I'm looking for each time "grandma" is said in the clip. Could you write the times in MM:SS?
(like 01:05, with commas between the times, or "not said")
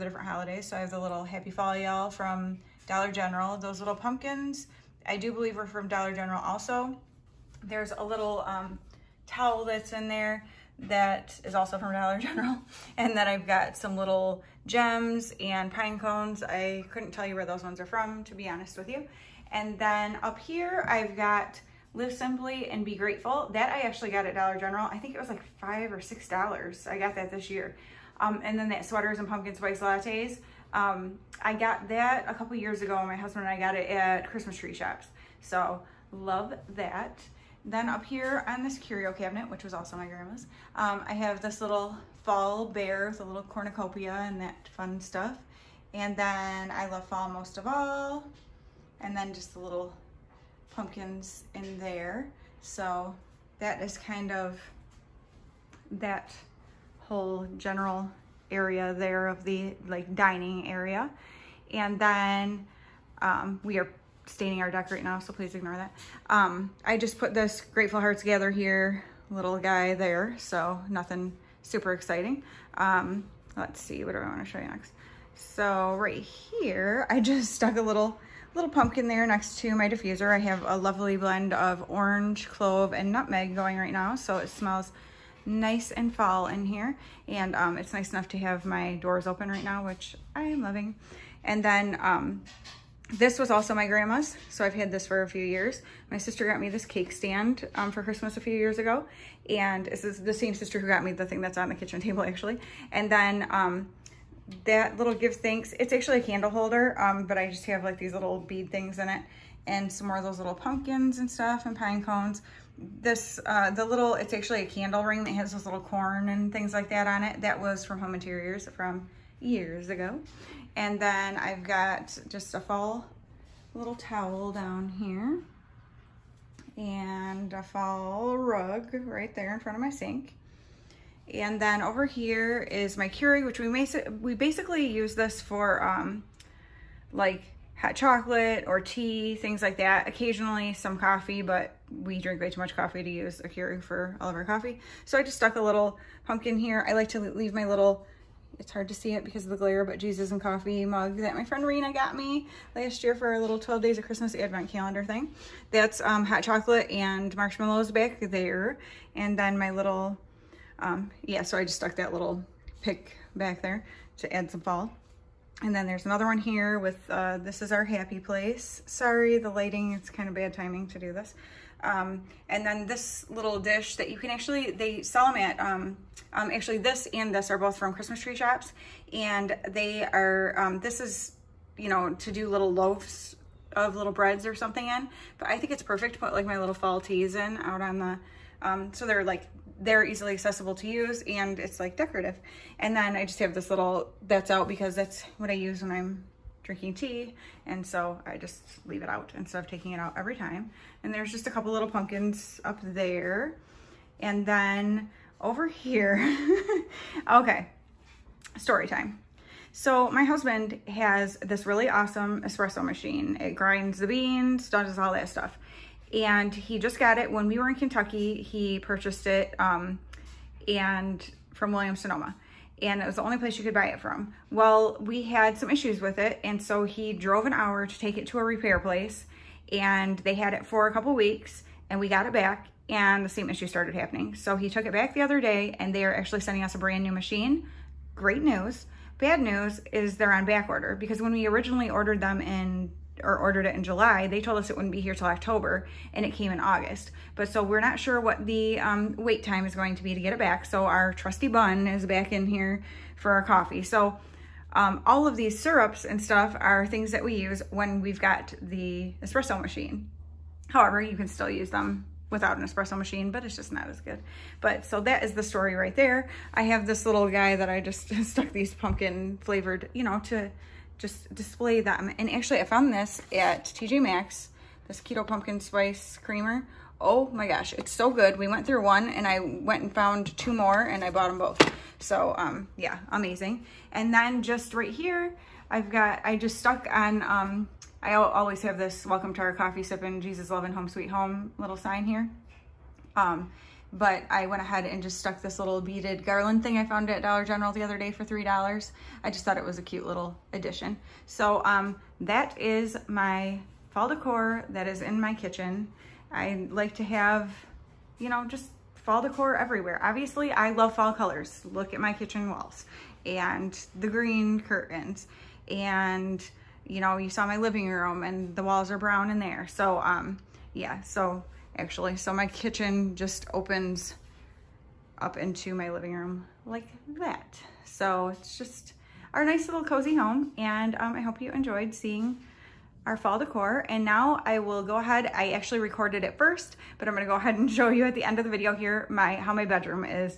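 00:40, 01:33.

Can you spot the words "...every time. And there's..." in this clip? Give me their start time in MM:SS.
03:20.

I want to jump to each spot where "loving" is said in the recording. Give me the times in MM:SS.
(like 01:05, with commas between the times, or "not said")
01:30, 04:50.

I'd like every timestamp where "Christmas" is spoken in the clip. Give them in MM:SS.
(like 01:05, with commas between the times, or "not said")
00:34, 01:38, 02:34, 02:57.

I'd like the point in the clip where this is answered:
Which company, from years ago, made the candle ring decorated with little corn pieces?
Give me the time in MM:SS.
01:58.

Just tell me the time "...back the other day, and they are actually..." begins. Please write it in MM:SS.
03:54.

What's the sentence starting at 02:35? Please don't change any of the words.
That's um, hot chocolate and marshmallows back there.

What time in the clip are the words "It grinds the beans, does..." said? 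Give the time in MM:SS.
03:33.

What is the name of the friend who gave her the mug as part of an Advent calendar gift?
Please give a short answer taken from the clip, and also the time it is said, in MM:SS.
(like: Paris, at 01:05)
Rena, at 02:31.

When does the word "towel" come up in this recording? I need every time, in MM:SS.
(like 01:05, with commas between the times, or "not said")
00:09, 02:03.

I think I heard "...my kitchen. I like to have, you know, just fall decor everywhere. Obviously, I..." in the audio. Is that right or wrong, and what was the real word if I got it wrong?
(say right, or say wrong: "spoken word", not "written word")
right.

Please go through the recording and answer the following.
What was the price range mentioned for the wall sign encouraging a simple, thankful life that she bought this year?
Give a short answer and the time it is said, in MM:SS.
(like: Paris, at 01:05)
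$5 or $6, at 00:25.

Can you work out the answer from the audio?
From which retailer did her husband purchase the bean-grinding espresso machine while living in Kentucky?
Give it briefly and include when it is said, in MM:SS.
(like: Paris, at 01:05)
Williams Sonoma, at 03:41.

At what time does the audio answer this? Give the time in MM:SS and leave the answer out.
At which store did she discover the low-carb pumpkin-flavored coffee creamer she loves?
04:33.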